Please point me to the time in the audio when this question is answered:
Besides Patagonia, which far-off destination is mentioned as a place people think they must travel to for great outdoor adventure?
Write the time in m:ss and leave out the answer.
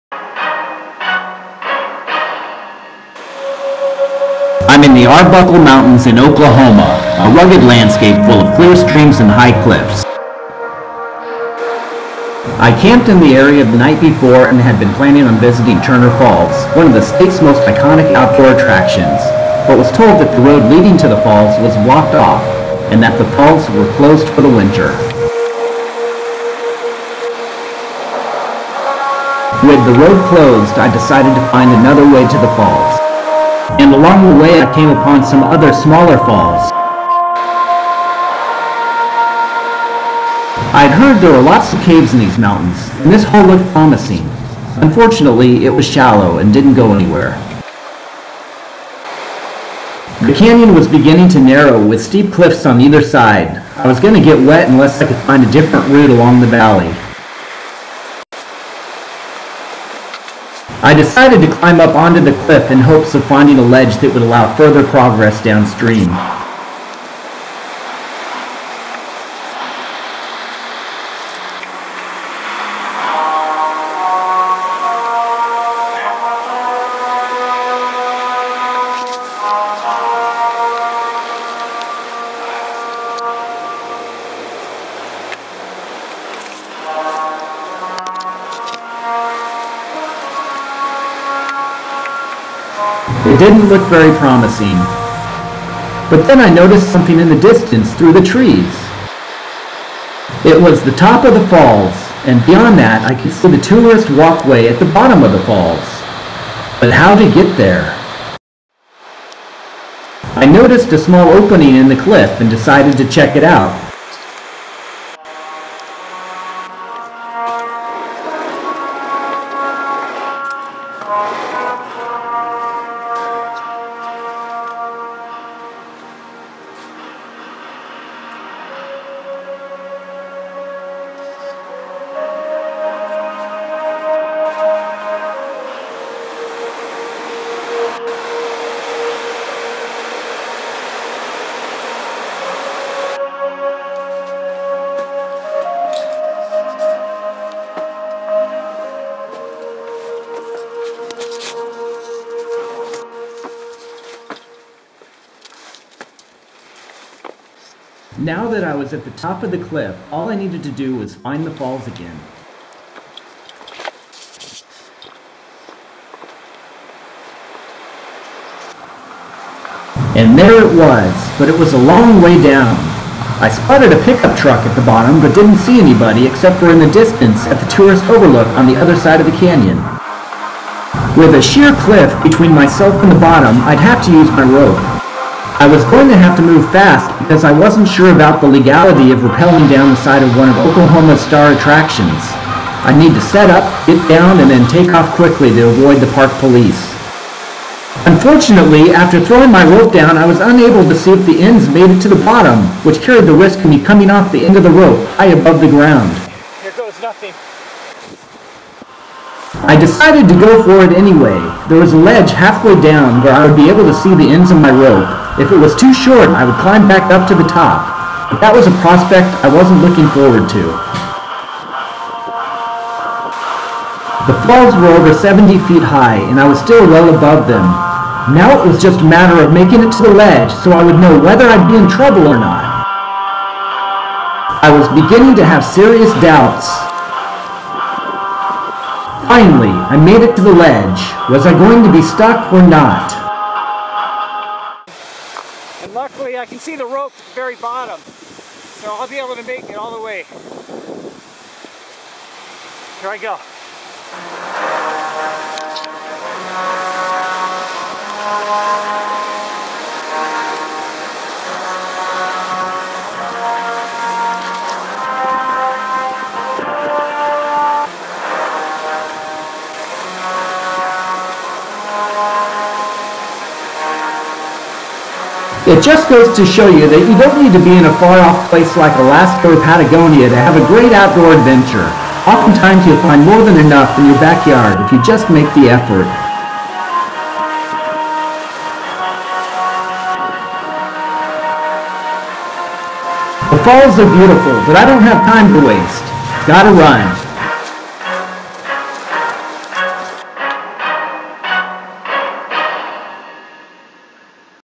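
4:38.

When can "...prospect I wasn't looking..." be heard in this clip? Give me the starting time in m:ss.
3:38.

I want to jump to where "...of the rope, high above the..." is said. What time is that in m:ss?
3:24.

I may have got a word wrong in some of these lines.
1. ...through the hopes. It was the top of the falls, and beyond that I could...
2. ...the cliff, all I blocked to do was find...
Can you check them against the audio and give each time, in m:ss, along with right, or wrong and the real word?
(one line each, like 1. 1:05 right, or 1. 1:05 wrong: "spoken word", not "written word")
1. 1:37 wrong: "trees", not "hopes"
2. 2:39 wrong: "needed", not "blocked".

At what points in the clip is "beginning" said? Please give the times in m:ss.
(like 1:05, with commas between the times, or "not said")
0:50, 3:54.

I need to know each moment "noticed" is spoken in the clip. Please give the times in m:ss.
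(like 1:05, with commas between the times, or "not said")
1:36, 1:50.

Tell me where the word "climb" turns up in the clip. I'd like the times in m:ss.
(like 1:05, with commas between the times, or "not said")
1:01, 3:36.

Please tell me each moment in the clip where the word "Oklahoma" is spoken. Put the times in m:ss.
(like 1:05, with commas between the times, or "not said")
0:06, 3:10.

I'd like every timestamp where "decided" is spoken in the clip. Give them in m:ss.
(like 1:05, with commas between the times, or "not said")
0:30, 1:00, 1:52, 3:29.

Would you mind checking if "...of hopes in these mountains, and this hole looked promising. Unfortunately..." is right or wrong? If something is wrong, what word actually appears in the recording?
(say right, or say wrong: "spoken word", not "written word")
wrong: "caves", not "hopes".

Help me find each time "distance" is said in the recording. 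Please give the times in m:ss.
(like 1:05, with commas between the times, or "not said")
1:37, 2:56.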